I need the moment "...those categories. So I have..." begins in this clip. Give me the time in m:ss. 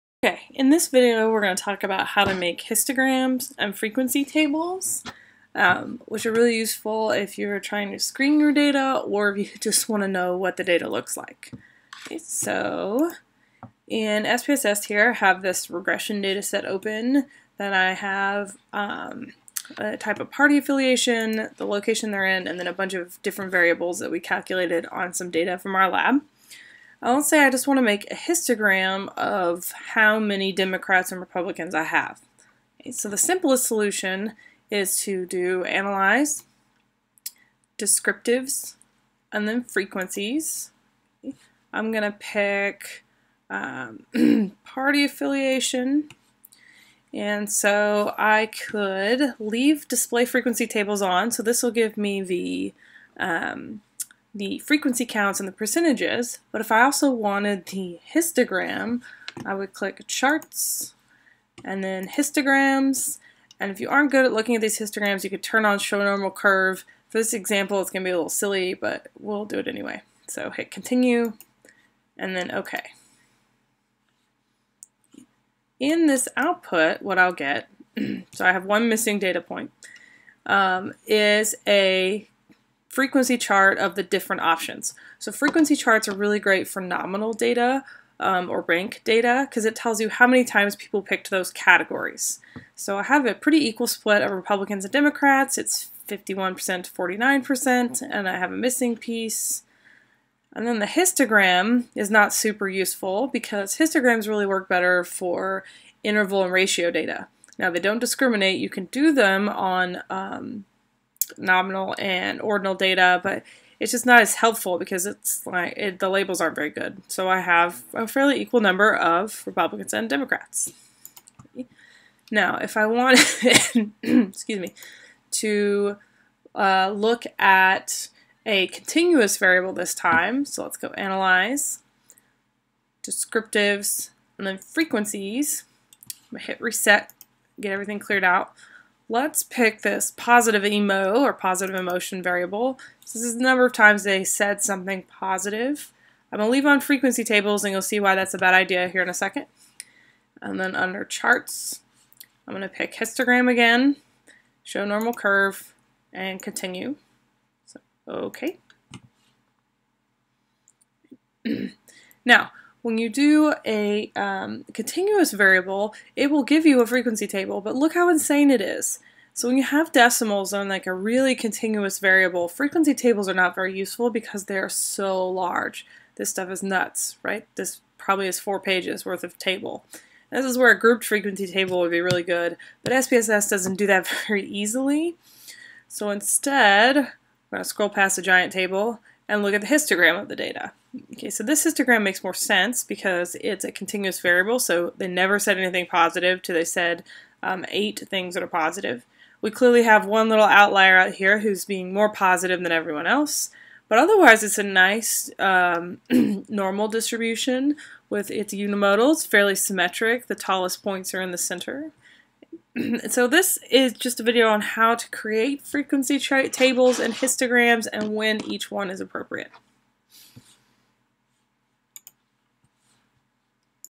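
1:31.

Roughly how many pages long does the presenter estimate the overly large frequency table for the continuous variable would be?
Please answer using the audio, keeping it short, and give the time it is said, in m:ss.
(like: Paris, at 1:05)
4, at 2:58.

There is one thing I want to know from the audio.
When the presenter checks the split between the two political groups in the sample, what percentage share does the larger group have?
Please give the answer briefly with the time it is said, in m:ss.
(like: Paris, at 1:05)
51%, at 1:36.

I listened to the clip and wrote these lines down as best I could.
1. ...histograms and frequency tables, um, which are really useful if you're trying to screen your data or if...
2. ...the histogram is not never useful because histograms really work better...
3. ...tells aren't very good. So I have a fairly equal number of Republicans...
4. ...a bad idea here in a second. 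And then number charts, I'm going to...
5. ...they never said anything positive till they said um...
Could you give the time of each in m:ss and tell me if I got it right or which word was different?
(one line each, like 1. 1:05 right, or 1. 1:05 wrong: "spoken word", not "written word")
1. 0:02 right
2. 1:40 wrong: "super", not "never"
3. 1:56 wrong: "labels", not "tells"
4. 2:28 wrong: "under", not "number"
5. 3:14 right.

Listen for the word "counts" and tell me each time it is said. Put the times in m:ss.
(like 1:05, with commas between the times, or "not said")
0:55.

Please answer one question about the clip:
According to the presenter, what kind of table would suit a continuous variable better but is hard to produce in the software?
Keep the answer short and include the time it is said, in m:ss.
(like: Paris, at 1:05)
grouped frequency table, at 3:00.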